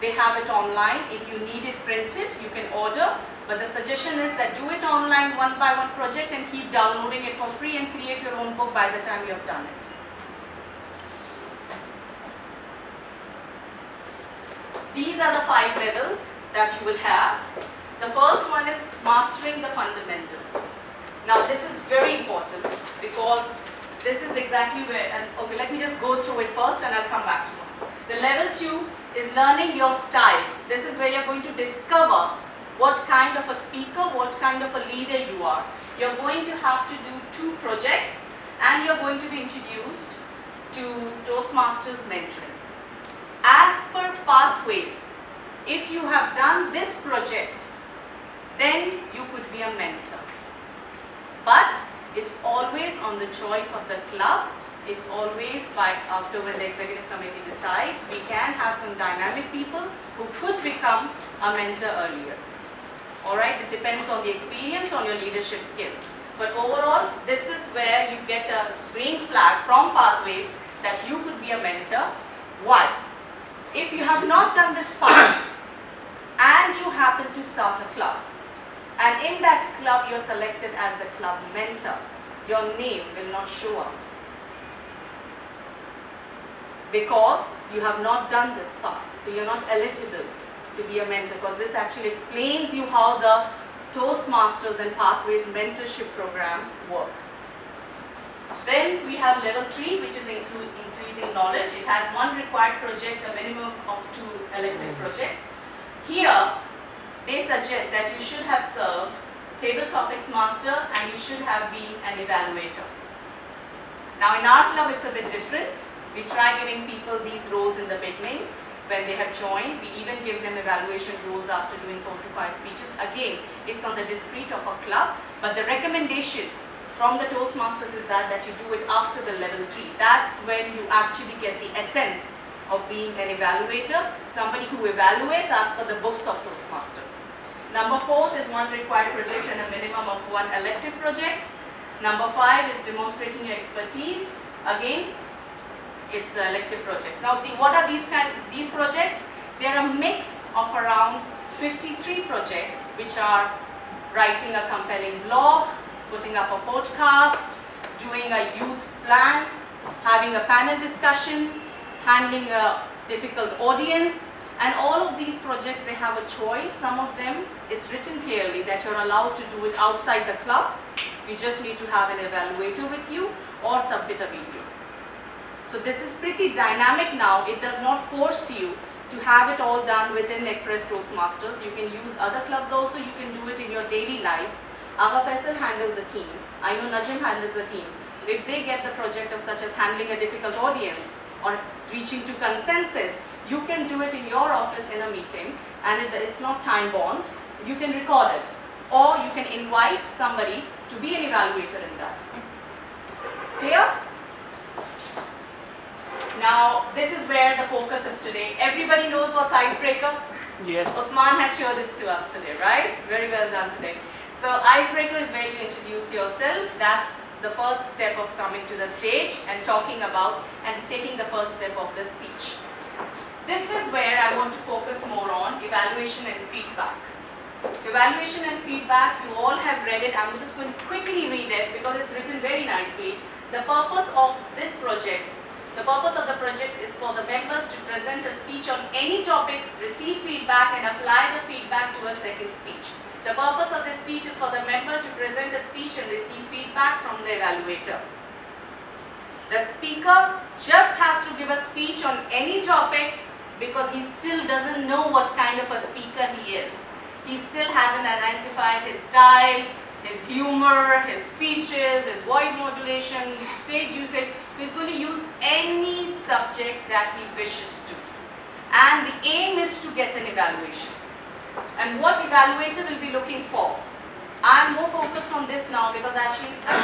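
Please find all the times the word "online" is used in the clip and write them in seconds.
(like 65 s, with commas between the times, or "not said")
0 s, 4 s.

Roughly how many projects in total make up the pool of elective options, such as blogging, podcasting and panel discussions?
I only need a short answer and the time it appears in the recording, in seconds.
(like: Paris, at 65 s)
53, at 151 s.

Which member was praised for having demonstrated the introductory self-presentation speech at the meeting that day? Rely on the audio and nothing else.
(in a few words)
Osman.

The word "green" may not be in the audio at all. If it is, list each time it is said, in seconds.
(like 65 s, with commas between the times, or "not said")
68 s.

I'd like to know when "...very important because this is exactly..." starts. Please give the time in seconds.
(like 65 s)
21 s.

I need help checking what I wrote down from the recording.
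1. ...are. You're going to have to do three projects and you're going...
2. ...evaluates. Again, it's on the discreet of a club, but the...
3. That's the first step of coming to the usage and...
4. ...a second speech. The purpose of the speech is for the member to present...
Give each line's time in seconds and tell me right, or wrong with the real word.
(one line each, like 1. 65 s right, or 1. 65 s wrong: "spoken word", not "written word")
1. 35 s wrong: "two", not "three"
2. 122 s wrong: "speeches", not "evaluates"
3. 216 s wrong: "stage", not "usage"
4. 242 s right.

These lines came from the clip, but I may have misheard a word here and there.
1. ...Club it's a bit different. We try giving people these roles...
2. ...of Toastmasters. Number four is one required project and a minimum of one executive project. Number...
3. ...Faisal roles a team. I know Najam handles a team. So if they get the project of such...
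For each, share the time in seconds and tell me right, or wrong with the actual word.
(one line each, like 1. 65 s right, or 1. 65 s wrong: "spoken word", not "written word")
1. 114 s right
2. 136 s wrong: "elective", not "executive"
3. 185 s wrong: "handles", not "roles".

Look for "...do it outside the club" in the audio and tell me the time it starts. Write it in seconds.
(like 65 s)
169 s.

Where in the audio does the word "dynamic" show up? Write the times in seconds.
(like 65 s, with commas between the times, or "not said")
58 s, 176 s.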